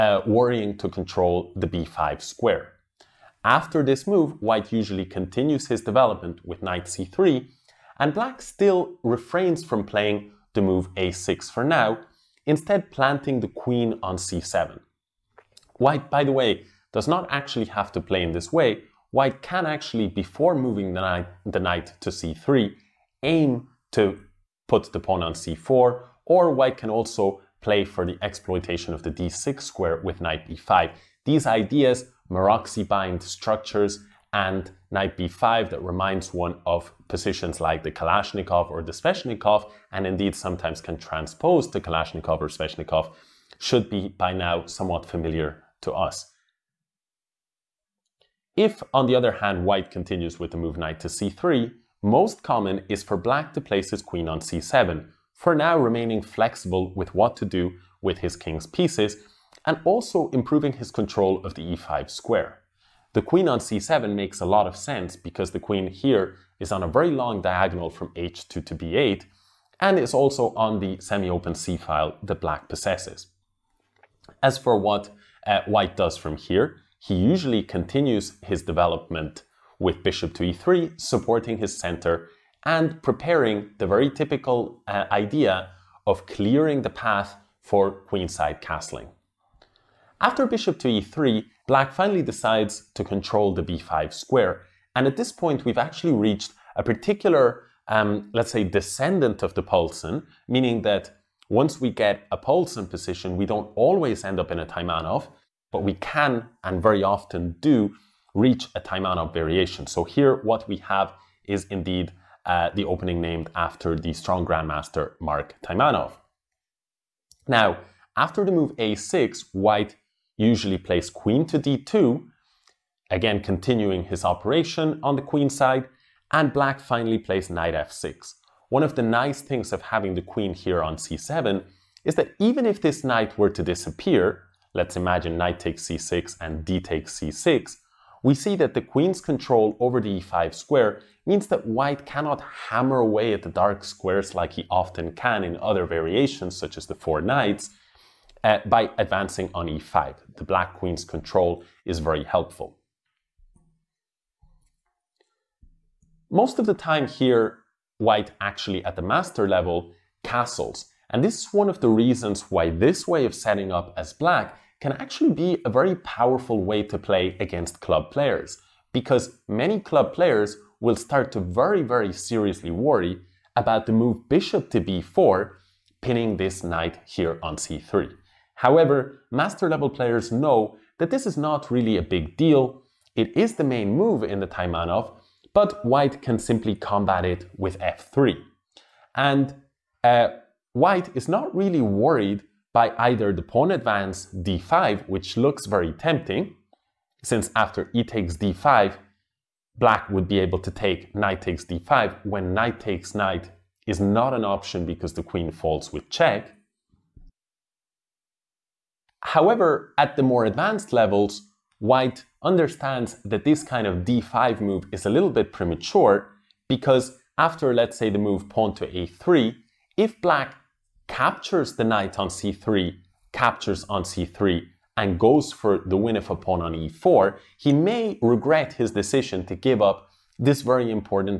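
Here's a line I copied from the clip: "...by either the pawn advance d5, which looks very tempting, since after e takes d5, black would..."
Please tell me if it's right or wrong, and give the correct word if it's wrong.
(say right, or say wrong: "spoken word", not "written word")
right.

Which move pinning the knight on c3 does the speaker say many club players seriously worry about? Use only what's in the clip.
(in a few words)
bishop to b4.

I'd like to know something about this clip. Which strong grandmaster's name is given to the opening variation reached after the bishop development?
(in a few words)
Mark Taimanov.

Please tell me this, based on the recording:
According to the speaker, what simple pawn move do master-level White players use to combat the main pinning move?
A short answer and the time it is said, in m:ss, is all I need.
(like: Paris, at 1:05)
f3, at 3:07.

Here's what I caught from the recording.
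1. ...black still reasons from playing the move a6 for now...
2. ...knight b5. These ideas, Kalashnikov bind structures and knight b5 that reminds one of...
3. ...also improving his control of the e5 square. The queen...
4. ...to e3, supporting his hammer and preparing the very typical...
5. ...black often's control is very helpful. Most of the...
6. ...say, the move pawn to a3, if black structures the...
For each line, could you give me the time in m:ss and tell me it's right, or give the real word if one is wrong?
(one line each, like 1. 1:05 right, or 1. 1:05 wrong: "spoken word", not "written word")
1. 0:08 wrong: "refrains", not "reasons"
2. 0:30 wrong: "Maróczy", not "Kalashnikov"
3. 0:59 right
4. 1:20 wrong: "center", not "hammer"
5. 2:30 wrong: "queen", not "often"
6. 3:37 wrong: "captures", not "structures".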